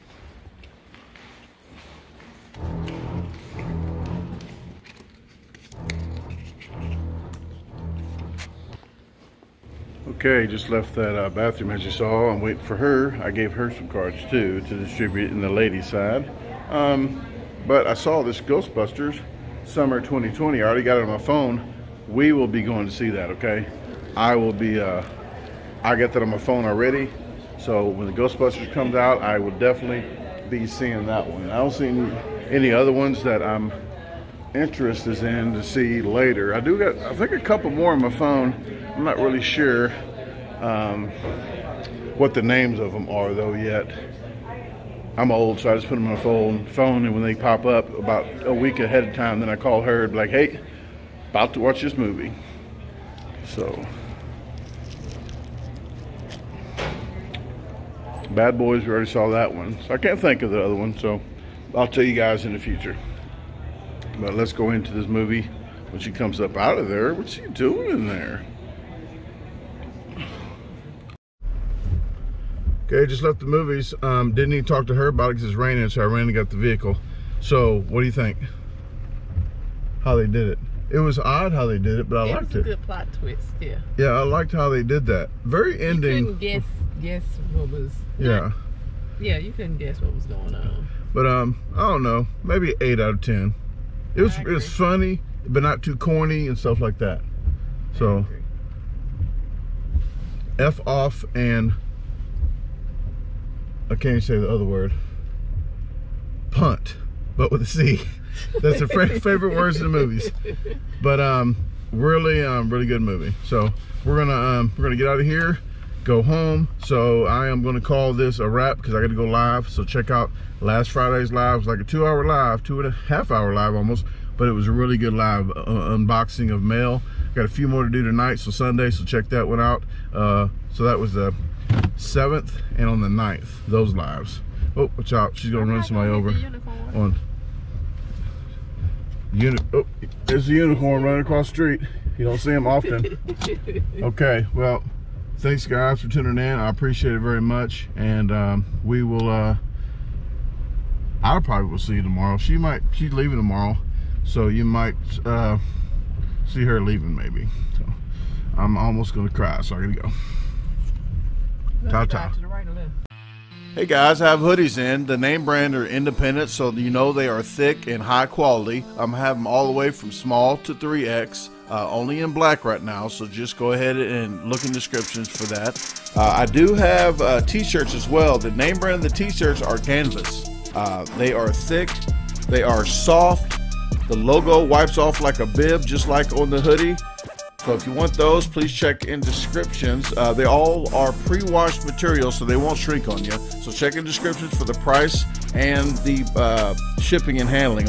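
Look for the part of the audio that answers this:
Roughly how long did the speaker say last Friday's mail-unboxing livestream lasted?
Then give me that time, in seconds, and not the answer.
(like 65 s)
122 s.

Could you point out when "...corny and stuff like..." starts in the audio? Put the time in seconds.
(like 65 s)
95 s.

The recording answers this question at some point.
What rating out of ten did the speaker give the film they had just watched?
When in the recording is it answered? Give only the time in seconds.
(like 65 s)
92 s.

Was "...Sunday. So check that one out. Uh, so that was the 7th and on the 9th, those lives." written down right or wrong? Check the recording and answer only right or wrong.
right.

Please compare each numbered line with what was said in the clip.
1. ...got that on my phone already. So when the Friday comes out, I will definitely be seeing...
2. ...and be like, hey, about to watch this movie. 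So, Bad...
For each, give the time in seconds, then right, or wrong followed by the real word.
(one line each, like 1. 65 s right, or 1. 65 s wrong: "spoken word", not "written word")
1. 25 s wrong: "Ghostbusters", not "Friday"
2. 50 s right.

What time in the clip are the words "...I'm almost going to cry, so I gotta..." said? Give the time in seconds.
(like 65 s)
158 s.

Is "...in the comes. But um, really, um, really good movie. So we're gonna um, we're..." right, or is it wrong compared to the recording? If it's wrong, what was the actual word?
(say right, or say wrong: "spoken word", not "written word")
wrong: "movies", not "comes".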